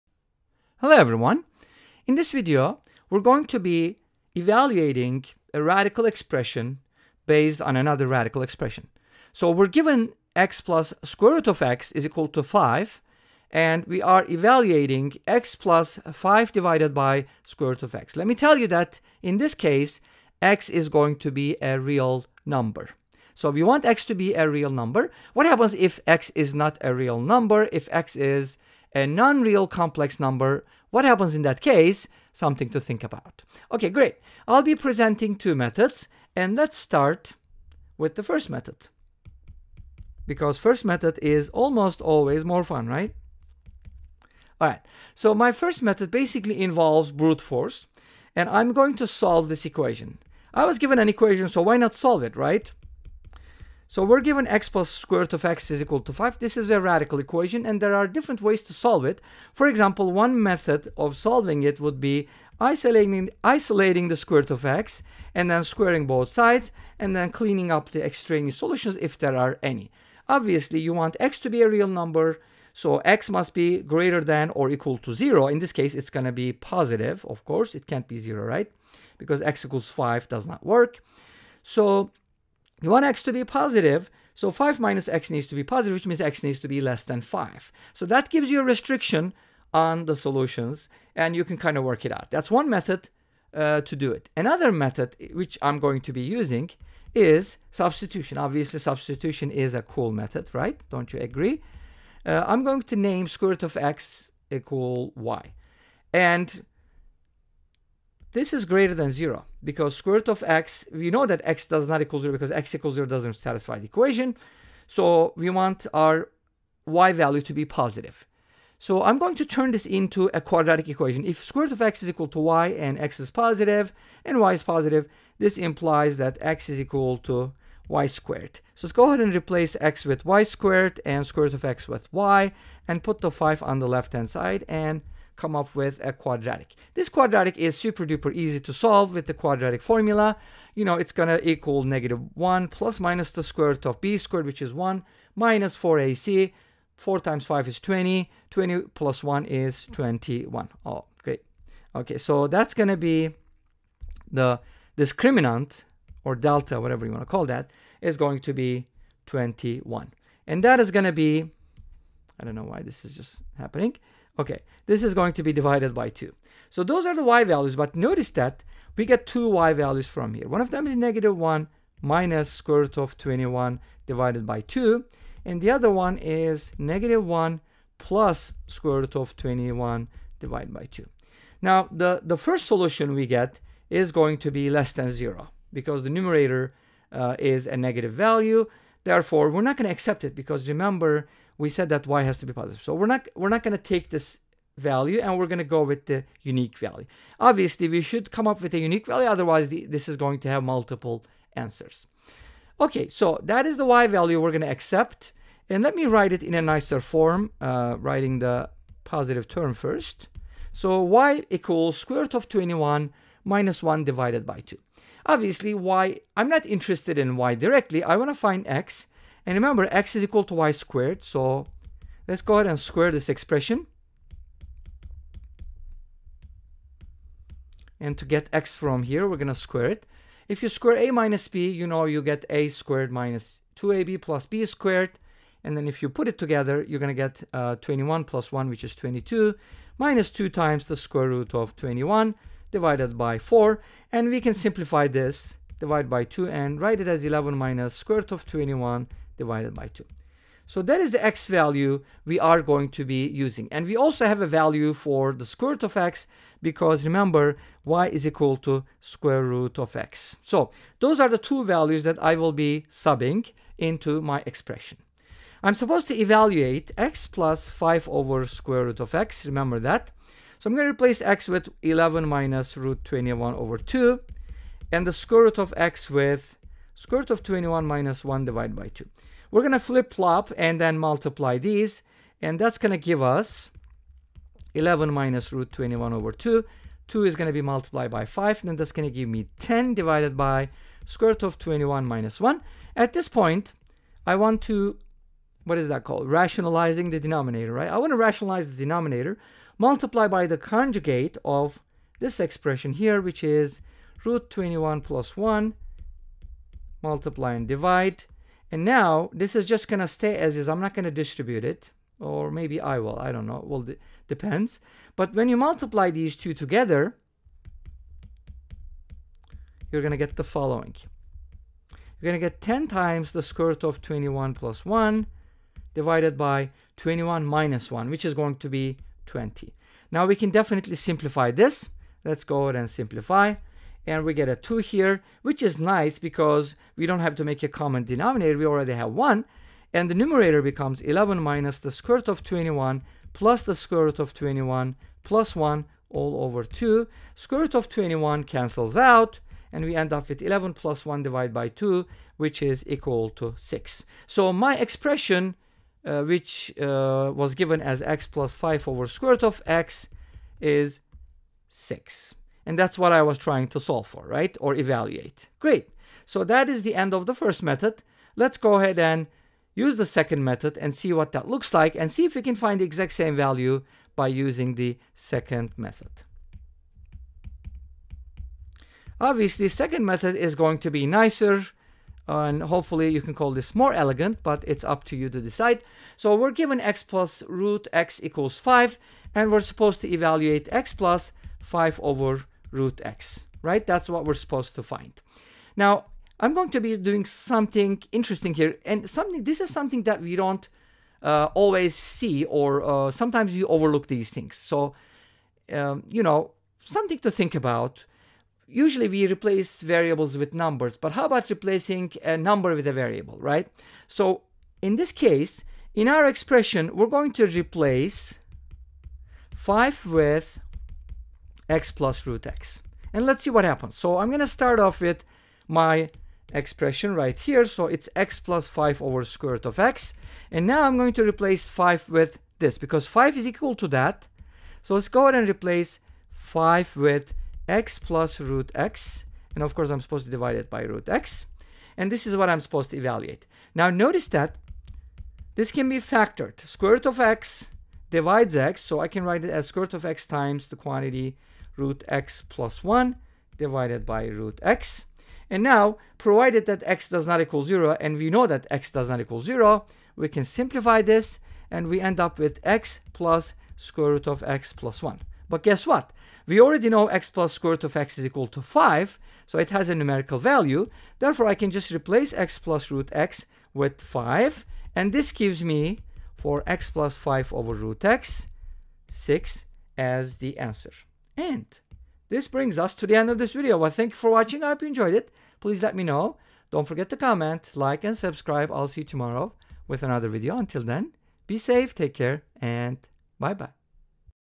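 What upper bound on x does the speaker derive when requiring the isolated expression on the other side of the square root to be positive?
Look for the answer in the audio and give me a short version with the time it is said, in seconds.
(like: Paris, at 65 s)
less than 5, at 86 s.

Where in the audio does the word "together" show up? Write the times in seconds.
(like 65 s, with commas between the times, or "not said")
236 s, 316 s.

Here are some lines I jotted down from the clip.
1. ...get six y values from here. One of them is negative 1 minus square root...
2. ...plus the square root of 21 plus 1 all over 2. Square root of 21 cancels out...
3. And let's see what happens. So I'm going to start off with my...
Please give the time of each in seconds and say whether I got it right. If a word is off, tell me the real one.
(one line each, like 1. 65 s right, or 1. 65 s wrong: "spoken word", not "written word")
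1. 169 s wrong: "two", not "six"
2. 343 s right
3. 423 s right.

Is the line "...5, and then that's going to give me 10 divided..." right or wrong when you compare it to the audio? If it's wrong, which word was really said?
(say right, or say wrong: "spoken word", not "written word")
right.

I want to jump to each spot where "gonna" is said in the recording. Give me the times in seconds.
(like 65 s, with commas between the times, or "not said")
141 s, 152 s, 160 s.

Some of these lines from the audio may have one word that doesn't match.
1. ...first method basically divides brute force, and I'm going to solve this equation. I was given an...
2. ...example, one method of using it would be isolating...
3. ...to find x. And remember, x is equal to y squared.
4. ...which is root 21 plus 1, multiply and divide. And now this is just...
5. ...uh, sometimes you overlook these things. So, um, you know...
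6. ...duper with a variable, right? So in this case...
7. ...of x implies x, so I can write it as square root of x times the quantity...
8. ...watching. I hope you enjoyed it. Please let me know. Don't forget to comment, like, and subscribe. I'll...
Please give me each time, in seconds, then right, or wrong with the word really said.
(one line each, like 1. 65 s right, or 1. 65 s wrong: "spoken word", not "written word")
1. 45 s wrong: "involves", not "divides"
2. 59 s wrong: "solving", not "using"
3. 218 s right
4. 303 s right
5. 402 s right
6. 412 s wrong: "number", not "duper"
7. 447 s wrong: "divides", not "implies"
8. 484 s right.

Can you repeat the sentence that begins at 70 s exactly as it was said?
Obviously, you want x to be a real number, so x must be greater than or equal to 0.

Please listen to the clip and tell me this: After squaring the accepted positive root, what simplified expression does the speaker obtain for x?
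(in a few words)
(11 - √21)/2.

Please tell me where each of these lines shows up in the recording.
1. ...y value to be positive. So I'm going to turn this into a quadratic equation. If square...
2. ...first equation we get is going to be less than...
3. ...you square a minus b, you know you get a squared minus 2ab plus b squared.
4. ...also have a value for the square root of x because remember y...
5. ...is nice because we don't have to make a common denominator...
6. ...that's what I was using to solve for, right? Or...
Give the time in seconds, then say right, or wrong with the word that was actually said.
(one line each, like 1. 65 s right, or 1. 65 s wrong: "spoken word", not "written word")
1. 116 s right
2. 182 s wrong: "solution", not "equation"
3. 230 s right
4. 253 s right
5. 335 s right
6. 362 s wrong: "trying", not "using".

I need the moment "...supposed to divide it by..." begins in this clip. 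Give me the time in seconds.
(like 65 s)
440 s.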